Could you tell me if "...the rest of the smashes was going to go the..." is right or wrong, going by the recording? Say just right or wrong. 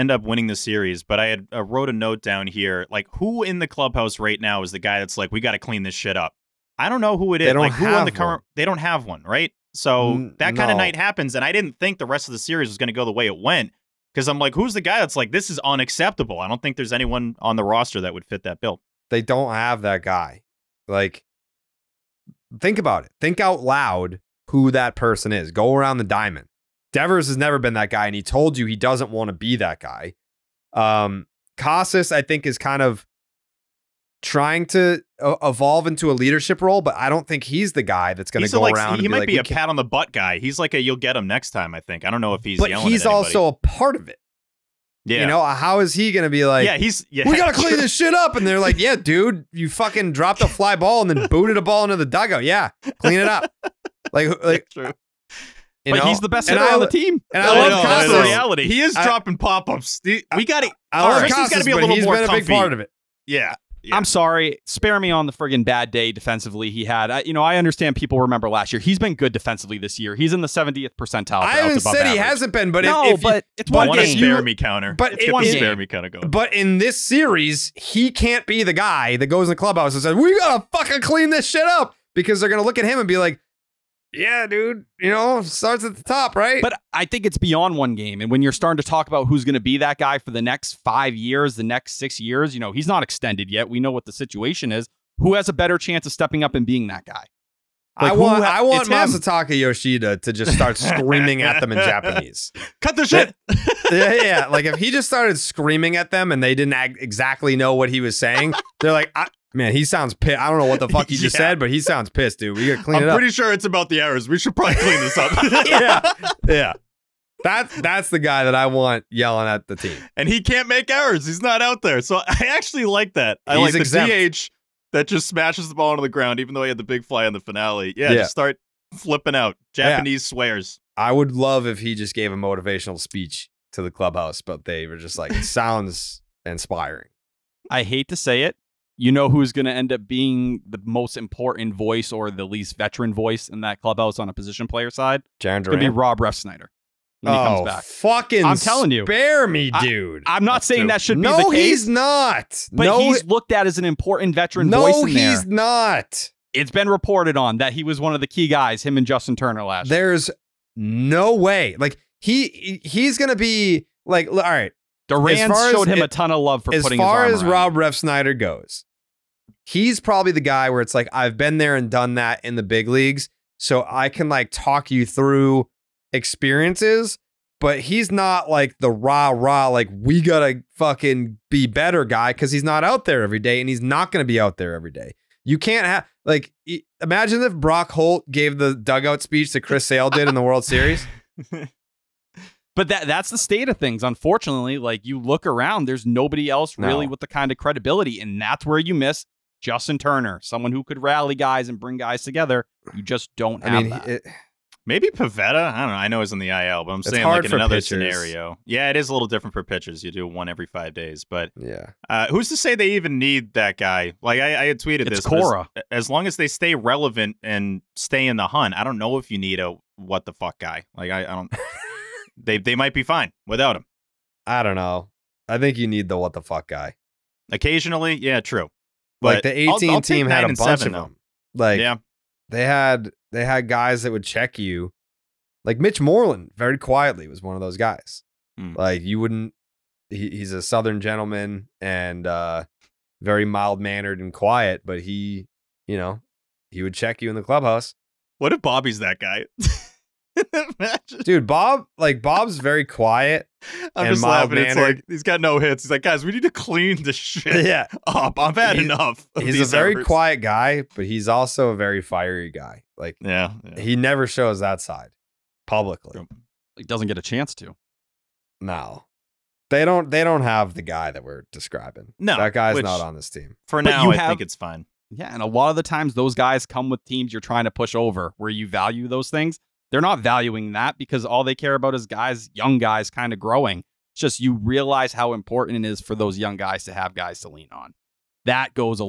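wrong.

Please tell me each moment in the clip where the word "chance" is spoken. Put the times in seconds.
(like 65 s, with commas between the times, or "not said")
95 s, 267 s.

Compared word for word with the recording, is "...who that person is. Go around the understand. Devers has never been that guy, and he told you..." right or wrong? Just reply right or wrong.
wrong.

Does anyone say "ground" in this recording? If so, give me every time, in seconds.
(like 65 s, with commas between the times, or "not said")
126 s.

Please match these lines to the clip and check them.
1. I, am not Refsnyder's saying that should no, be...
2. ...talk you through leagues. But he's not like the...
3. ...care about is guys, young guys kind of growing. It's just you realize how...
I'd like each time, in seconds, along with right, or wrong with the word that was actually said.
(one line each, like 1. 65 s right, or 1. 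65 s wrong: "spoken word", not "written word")
1. 150 s wrong: "That", not "Refsnyder"
2. 174 s wrong: "experiences", not "leagues"
3. 281 s right.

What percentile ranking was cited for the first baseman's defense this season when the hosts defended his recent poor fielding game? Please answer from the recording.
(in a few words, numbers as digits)
70th percentile.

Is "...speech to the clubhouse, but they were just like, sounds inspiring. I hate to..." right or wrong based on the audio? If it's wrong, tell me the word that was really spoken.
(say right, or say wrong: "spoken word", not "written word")
right.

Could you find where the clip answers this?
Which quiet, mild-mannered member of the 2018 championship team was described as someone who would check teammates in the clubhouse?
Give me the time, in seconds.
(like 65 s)
235 s.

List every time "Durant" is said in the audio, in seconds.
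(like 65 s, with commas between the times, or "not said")
165 s.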